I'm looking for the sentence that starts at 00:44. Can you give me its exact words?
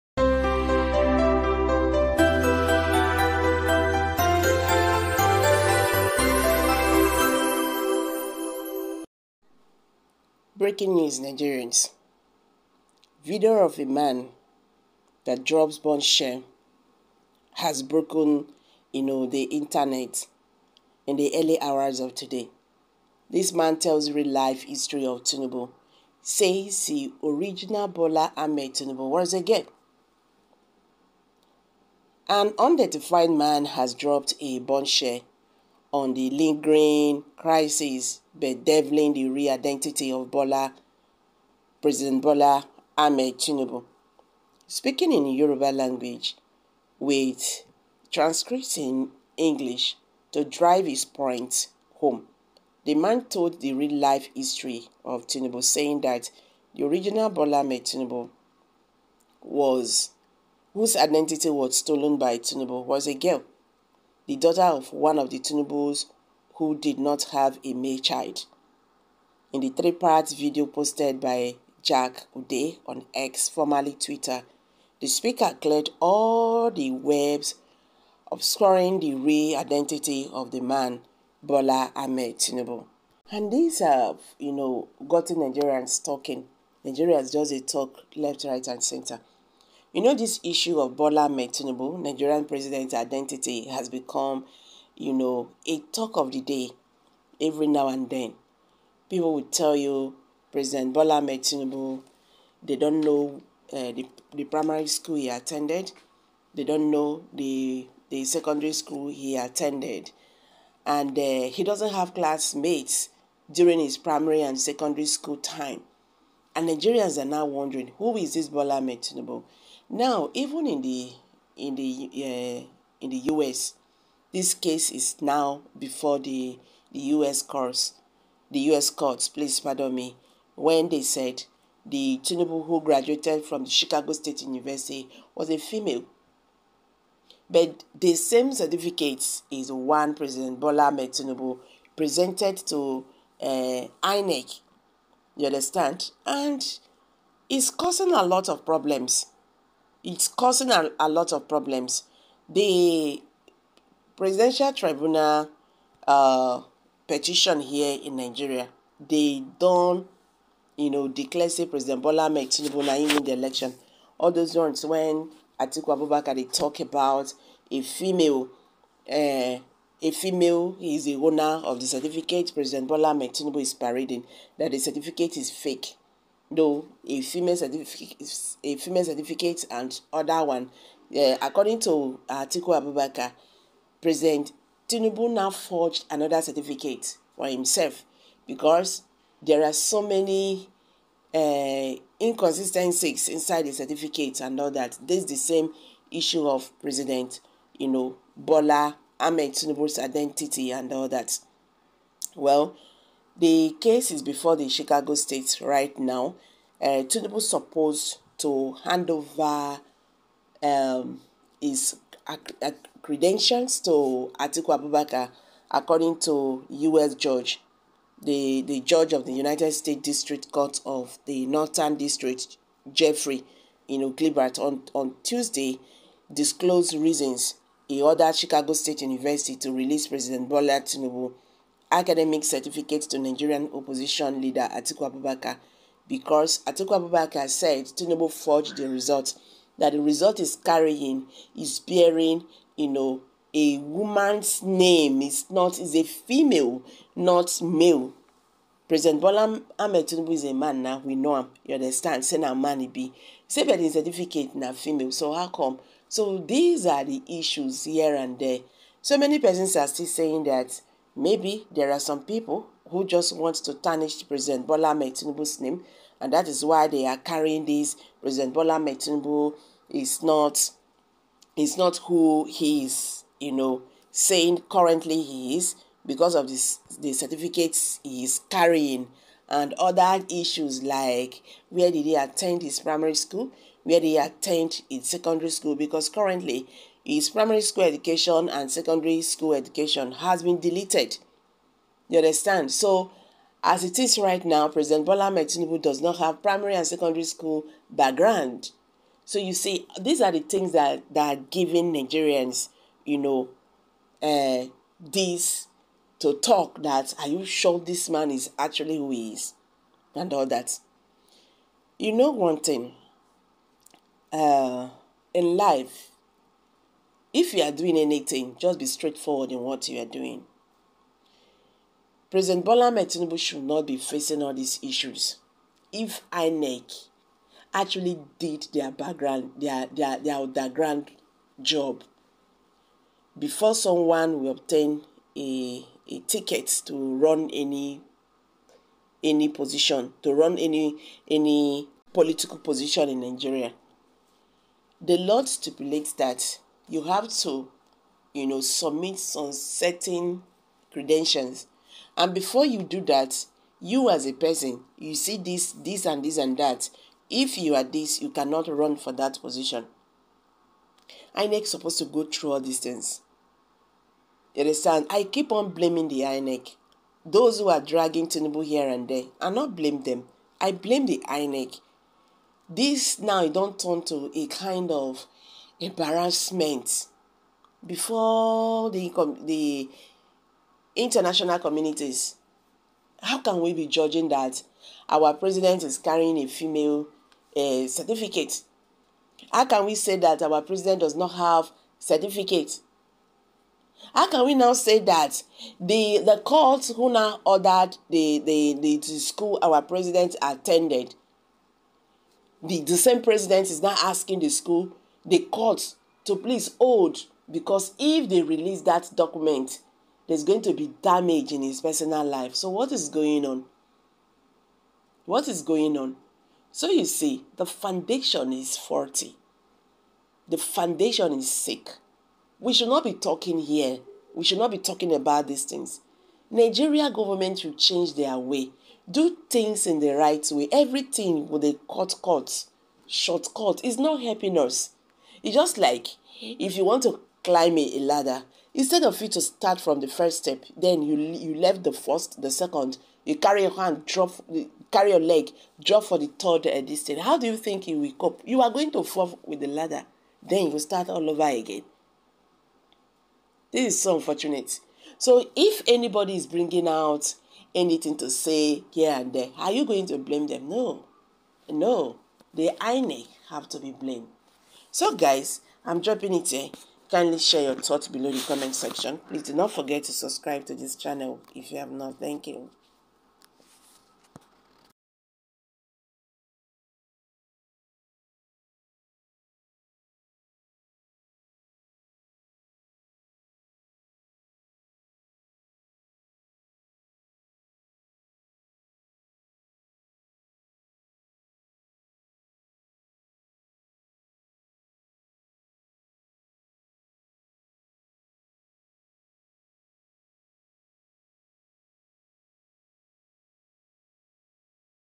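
Speaking in Yoruba language with transcripts in English to drive his point home.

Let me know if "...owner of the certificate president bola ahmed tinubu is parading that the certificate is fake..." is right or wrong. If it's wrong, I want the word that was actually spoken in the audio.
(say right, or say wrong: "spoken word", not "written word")
right.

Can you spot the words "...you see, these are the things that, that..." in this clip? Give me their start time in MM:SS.
04:59.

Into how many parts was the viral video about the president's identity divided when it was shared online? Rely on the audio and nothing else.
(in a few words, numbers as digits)
3.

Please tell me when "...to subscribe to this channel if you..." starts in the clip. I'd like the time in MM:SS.
07:50.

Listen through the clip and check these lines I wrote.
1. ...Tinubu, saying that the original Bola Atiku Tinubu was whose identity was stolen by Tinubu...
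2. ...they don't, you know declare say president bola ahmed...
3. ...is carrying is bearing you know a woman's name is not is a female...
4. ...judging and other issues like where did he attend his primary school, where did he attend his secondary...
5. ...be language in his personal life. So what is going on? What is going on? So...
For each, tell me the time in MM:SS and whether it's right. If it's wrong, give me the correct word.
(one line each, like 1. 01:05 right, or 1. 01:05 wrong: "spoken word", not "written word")
1. 00:55 wrong: "Ahmed", not "Atiku"
2. 02:39 right
3. 04:00 right
4. 04:38 wrong: "carrying", not "judging"
5. 06:50 wrong: "damage", not "language".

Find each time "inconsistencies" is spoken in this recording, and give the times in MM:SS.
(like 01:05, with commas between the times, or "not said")
03:12.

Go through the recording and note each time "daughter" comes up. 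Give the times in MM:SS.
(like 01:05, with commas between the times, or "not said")
01:04.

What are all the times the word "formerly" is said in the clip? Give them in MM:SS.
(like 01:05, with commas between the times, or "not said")
01:13.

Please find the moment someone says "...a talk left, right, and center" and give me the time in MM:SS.
01:27.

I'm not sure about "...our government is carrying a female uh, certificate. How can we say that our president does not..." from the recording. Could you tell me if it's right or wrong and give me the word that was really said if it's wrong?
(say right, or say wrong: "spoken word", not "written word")
wrong: "president", not "government".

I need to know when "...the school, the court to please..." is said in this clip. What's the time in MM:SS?
06:44.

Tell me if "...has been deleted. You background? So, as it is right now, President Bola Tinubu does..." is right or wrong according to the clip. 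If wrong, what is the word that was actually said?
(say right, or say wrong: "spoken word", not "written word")
wrong: "understand", not "background".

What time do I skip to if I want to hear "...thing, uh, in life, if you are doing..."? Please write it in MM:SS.
05:12.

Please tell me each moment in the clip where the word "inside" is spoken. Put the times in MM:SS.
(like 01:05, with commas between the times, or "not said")
03:13.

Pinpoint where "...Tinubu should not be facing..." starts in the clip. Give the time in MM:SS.
05:22.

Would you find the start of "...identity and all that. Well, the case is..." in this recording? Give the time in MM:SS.
03:19.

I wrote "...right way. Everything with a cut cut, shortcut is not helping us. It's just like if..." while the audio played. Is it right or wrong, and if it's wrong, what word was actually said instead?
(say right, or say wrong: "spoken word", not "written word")
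right.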